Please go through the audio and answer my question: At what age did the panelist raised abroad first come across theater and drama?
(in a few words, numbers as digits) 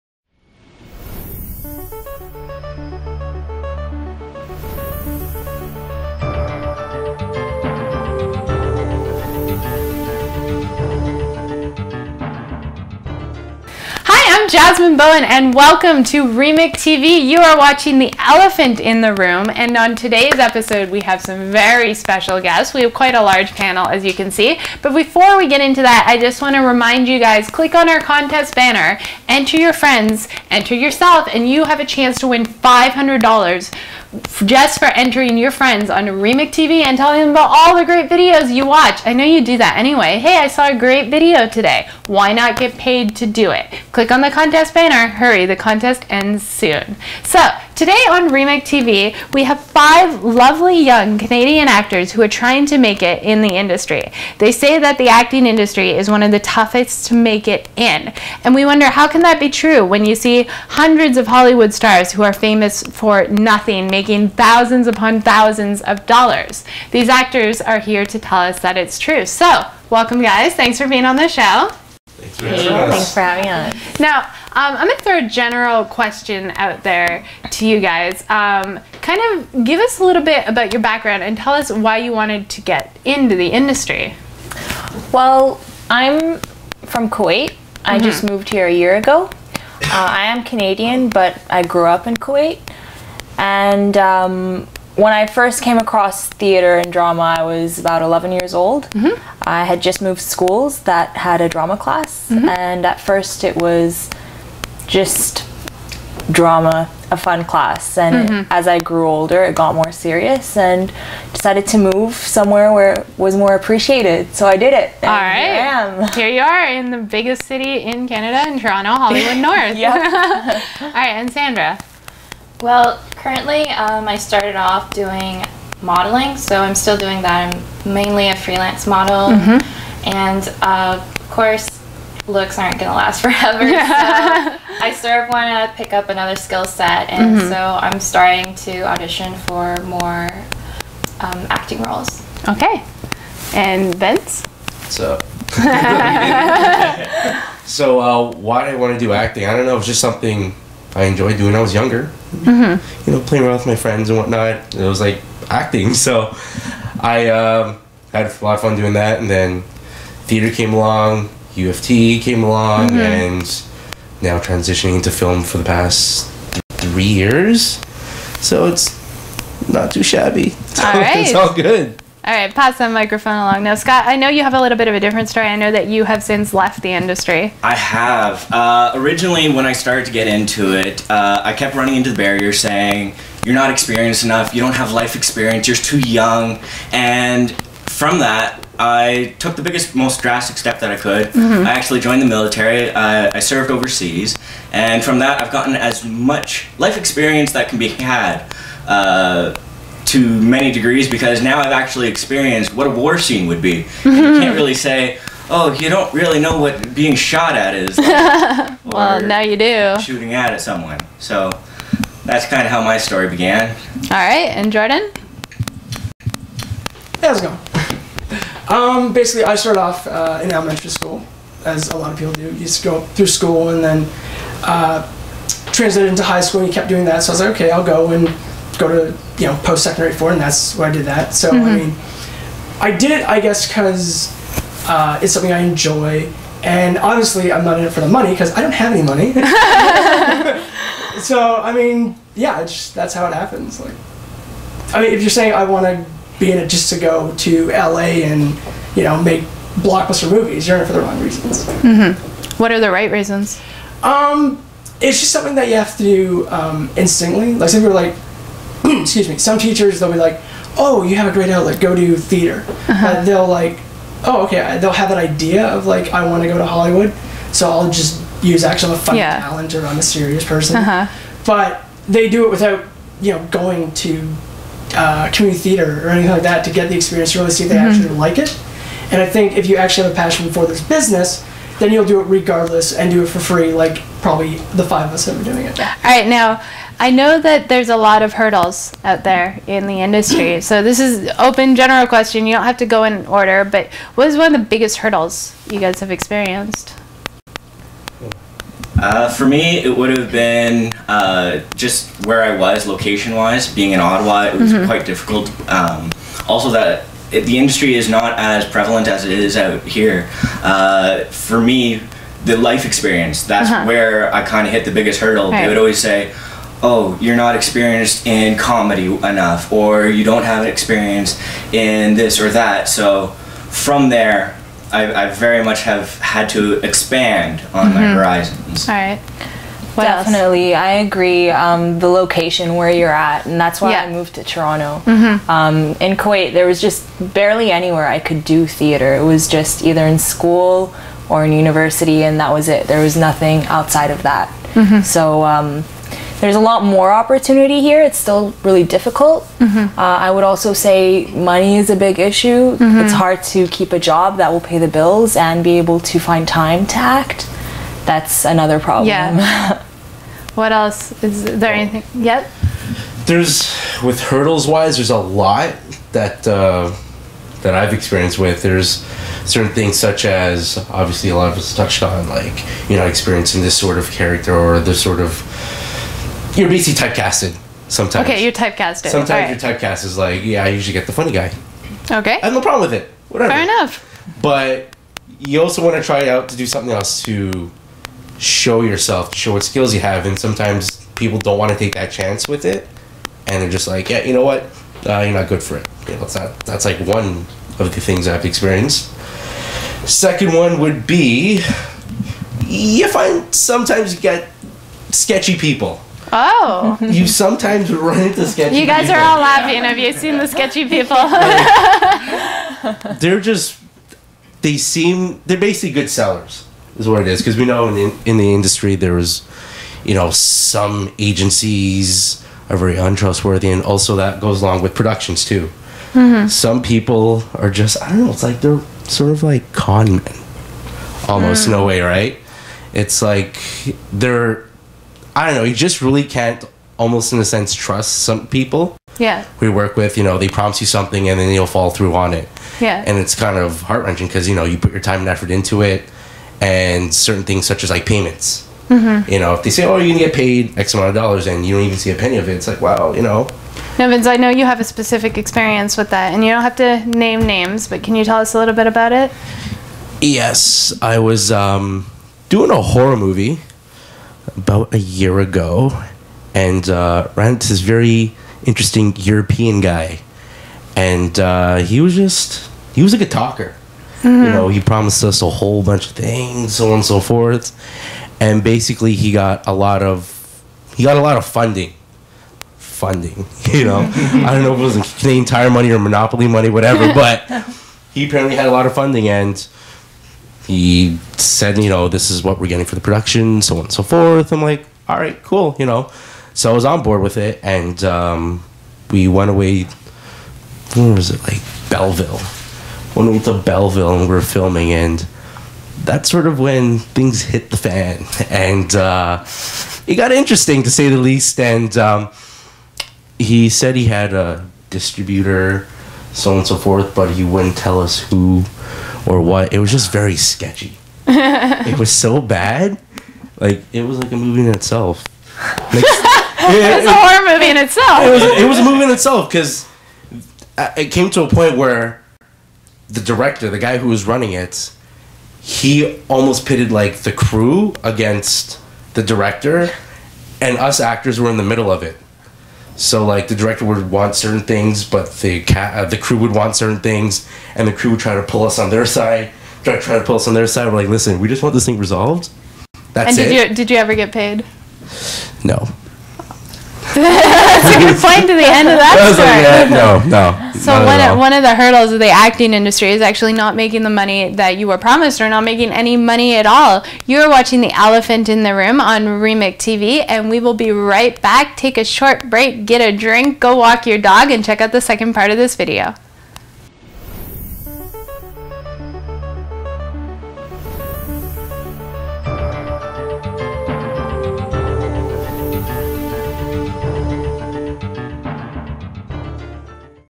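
11.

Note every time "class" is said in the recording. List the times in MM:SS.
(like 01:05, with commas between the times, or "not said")
01:41, 01:47.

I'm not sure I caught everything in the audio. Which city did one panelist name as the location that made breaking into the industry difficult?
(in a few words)
Ottawa.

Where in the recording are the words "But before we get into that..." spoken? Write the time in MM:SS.
00:24.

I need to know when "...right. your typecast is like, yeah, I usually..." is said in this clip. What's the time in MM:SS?
06:19.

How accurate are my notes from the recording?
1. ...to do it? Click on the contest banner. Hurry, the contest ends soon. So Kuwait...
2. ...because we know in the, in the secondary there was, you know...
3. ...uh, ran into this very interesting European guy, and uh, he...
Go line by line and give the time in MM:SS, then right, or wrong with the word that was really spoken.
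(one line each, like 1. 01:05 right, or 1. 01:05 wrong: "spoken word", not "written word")
1. 00:43 wrong: "Today", not "Kuwait"
2. 06:57 wrong: "industry", not "secondary"
3. 07:46 right.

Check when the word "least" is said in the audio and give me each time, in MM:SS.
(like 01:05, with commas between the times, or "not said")
08:31.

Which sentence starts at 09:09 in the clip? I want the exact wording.
Try try to pull us on their side.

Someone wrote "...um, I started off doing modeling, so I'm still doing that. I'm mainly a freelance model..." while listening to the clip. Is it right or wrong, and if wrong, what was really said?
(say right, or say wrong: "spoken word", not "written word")
right.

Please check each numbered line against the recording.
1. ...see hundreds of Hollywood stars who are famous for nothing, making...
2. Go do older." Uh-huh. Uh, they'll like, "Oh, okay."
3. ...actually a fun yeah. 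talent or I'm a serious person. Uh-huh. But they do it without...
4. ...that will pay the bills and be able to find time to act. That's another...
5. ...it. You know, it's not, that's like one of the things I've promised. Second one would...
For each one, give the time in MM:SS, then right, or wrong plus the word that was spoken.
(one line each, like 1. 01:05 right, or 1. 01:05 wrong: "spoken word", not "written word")
1. 01:00 right
2. 04:21 wrong: "theater", not "older"
3. 04:28 right
4. 05:54 right
5. 06:35 wrong: "experienced", not "promised".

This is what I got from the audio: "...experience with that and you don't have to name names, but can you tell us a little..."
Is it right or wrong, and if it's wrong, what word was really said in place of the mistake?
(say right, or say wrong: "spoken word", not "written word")
right.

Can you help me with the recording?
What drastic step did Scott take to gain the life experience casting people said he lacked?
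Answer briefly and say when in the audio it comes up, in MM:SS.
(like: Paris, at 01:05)
joined the military, at 03:12.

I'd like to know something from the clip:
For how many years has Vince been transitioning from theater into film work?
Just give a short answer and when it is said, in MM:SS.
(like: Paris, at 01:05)
3, at 02:46.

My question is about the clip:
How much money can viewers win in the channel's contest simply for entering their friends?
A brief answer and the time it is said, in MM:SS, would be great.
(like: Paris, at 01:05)
$500, at 00:32.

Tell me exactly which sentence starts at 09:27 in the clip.
You're watching The Elephant in the Room on Remic TV, and we will be right back.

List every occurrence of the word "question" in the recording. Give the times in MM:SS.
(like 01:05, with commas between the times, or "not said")
01:15, 04:52.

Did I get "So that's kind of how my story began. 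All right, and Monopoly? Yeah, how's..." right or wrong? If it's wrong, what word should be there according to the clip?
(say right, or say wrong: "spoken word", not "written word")
wrong: "Jordan", not "Monopoly".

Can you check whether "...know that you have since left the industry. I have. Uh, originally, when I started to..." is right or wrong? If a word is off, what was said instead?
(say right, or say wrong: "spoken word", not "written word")
right.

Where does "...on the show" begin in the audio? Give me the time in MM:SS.
01:11.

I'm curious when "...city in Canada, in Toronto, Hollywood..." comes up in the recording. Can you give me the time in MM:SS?
01:57.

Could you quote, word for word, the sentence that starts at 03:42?
You just go through school and then uh, translated into high school, and you kept doing that.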